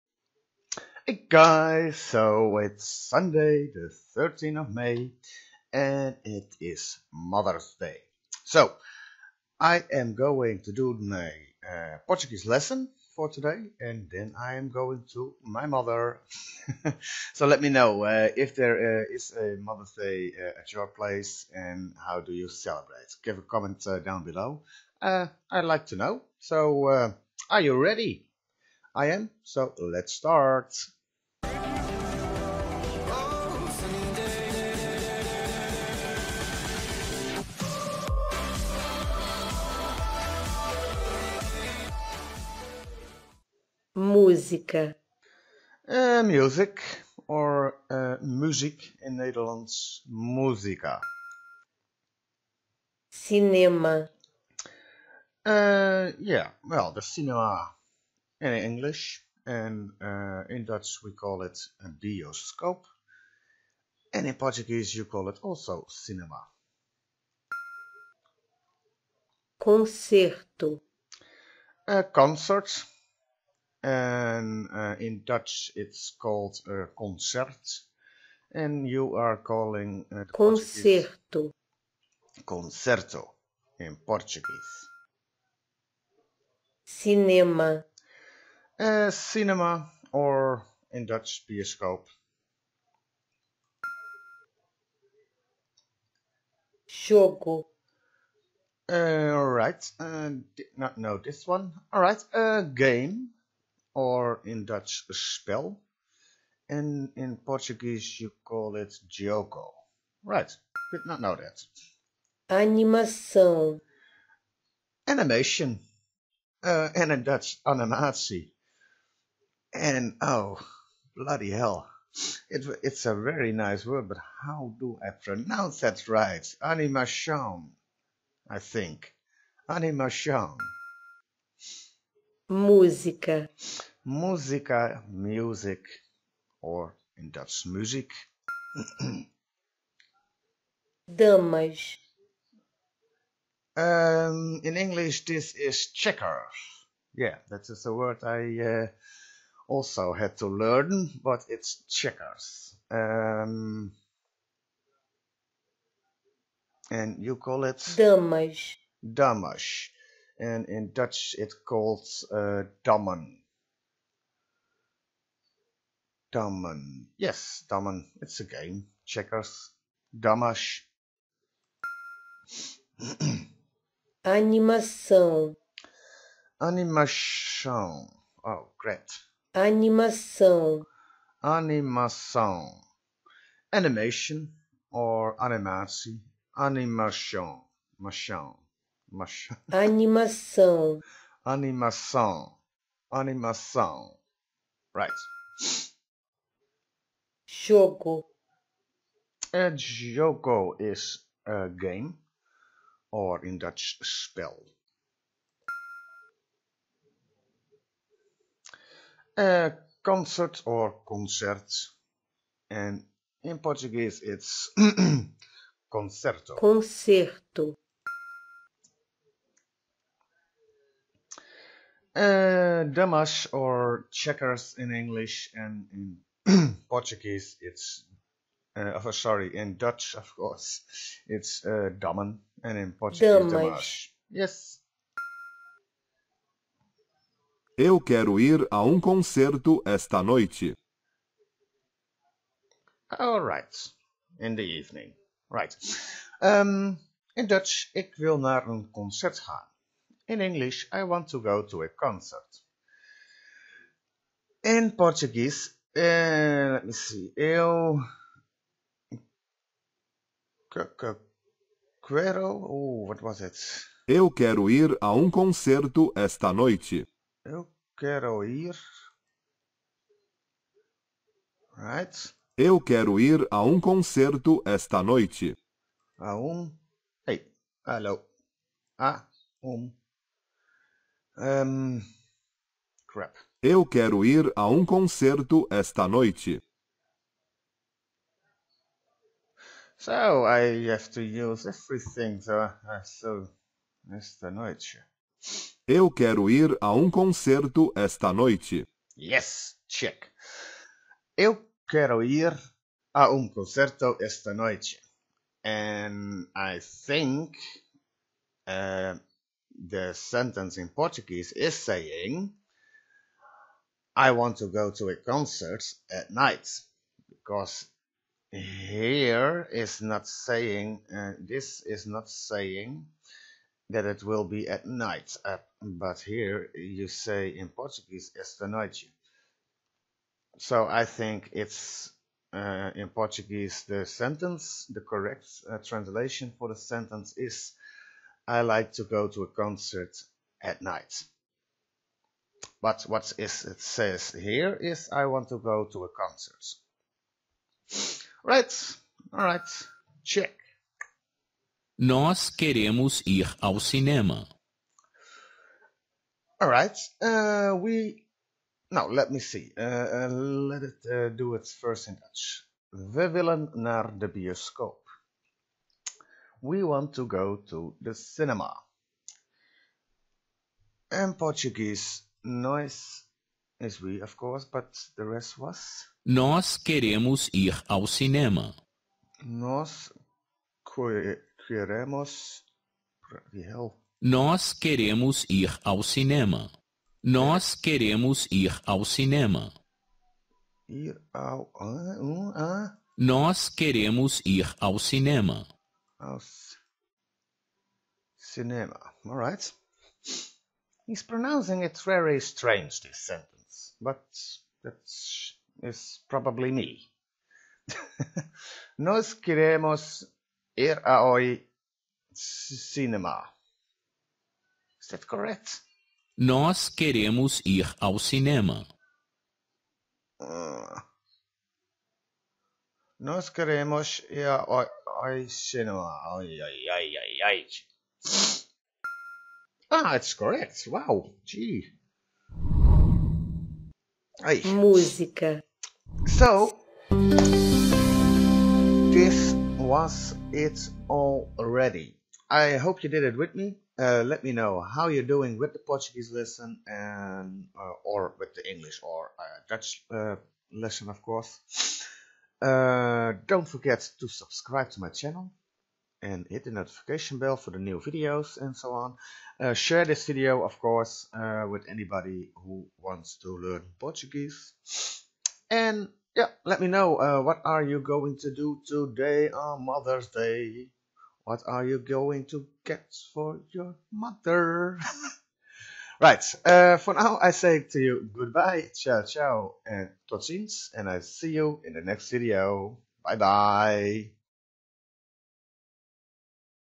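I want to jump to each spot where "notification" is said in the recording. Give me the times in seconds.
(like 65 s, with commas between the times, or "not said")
456 s.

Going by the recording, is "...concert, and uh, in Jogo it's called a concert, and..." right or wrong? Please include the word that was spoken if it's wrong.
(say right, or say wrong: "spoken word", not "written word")
wrong: "Dutch", not "Jogo".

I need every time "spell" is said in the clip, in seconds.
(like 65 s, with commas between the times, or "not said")
105 s, 204 s.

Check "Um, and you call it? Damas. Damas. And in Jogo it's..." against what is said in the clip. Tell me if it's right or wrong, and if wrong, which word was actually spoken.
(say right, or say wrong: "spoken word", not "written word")
wrong: "Dutch", not "Jogo".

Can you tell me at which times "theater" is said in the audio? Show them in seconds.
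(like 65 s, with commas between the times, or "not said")
not said.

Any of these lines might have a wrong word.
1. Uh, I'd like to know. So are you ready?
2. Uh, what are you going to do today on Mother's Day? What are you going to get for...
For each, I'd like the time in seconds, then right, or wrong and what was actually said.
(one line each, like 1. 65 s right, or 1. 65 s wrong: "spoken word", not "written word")
1. 25 s right
2. 467 s right.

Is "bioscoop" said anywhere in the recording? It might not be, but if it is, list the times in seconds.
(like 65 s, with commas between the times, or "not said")
61 s, 91 s, 364 s.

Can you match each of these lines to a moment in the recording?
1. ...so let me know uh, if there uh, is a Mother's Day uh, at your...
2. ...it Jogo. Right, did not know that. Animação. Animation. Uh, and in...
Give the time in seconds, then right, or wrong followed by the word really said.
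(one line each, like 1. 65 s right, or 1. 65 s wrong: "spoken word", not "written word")
1. 17 s right
2. 108 s right.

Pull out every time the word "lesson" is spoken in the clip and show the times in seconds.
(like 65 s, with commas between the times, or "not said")
12 s, 446 s, 450 s.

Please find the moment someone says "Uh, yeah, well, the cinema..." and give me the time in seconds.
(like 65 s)
55 s.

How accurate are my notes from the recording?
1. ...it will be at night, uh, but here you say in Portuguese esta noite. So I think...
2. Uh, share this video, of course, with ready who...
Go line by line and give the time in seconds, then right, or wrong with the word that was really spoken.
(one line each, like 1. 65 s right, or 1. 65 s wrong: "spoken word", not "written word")
1. 324 s right
2. 459 s wrong: "anybody", not "ready".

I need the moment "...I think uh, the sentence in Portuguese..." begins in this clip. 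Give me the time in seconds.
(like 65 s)
306 s.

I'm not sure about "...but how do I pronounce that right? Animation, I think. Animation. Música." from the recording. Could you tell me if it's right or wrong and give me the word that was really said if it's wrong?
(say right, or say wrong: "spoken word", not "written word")
right.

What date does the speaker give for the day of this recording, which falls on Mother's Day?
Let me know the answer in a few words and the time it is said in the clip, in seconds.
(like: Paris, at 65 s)
Sunday the 13th of May, at 2 s.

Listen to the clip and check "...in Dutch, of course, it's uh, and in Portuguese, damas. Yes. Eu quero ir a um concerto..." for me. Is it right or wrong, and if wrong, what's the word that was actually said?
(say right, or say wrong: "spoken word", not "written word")
right.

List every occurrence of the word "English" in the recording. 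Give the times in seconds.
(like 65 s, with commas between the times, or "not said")
58 s, 144 s, 224 s, 250 s, 448 s.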